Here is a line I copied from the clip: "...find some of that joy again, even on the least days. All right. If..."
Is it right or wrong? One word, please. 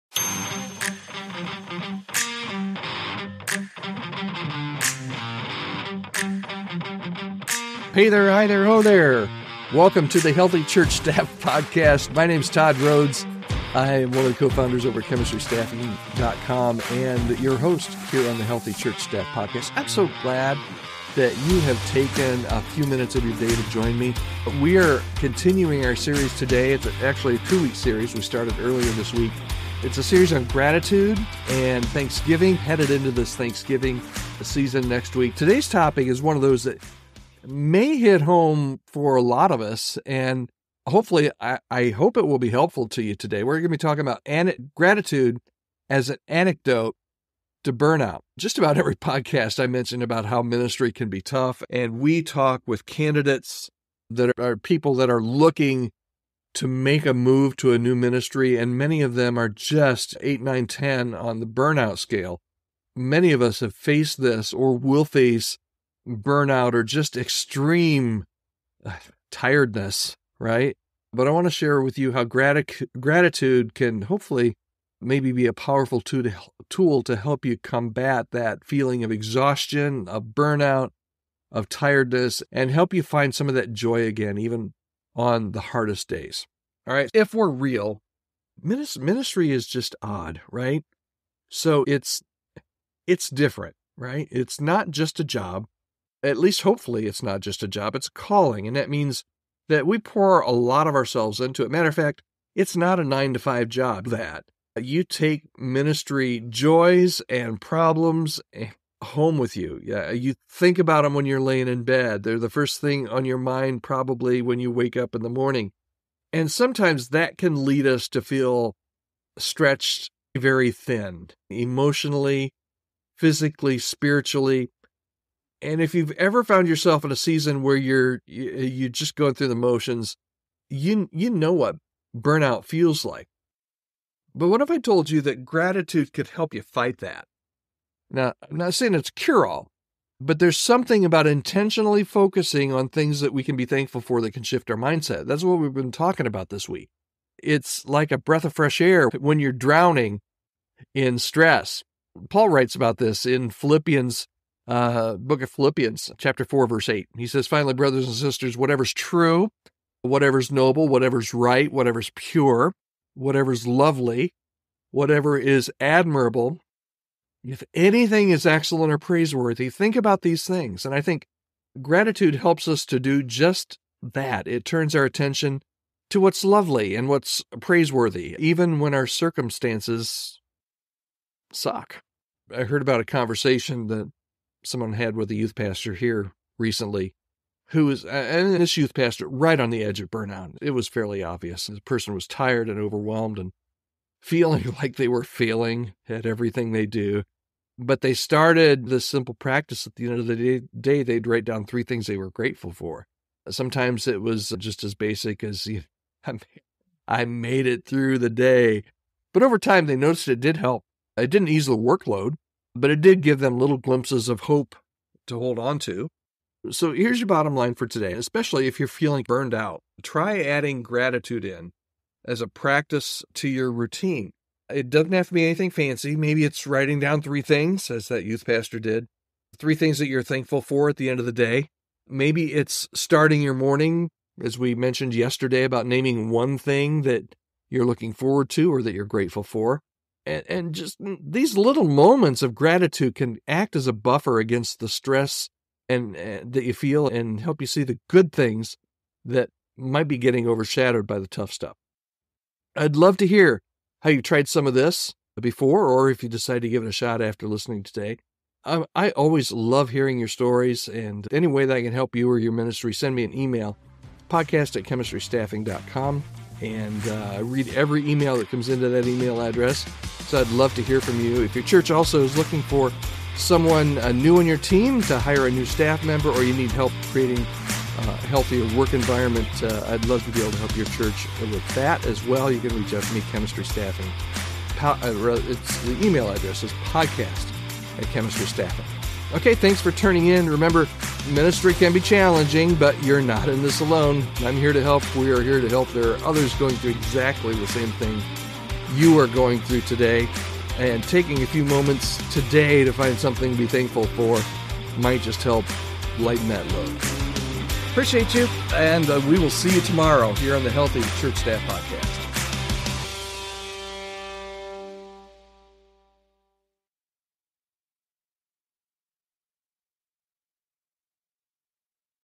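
wrong.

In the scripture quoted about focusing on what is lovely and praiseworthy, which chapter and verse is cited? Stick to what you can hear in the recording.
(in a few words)
Chapter 4, verse 8.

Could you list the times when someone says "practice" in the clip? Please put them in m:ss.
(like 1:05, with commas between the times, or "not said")
3:19, 3:42.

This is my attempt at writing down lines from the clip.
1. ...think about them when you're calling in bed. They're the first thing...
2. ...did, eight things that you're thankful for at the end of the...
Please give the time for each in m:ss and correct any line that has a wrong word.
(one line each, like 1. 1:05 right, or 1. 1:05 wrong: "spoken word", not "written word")
1. 1:50 wrong: "laying", not "calling"
2. 3:48 wrong: "three", not "eight".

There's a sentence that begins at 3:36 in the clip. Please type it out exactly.
So here's your bottom line for today, especially if you're feeling burned out.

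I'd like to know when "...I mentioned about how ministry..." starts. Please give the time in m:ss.
0:49.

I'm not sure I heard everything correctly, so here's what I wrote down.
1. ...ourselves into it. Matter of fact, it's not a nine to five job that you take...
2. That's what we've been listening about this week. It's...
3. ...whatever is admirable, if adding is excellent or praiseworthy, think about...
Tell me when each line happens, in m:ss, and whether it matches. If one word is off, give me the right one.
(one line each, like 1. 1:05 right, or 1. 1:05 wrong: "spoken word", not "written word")
1. 1:40 right
2. 2:25 wrong: "talking", not "listening"
3. 2:44 wrong: "anything", not "adding".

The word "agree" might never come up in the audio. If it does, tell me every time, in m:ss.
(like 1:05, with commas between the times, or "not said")
not said.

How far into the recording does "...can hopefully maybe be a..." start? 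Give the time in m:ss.
1:13.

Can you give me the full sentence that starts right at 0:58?
And many of them are just 8, 9, 10 on the burnout scale.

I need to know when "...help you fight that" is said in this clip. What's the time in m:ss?
2:16.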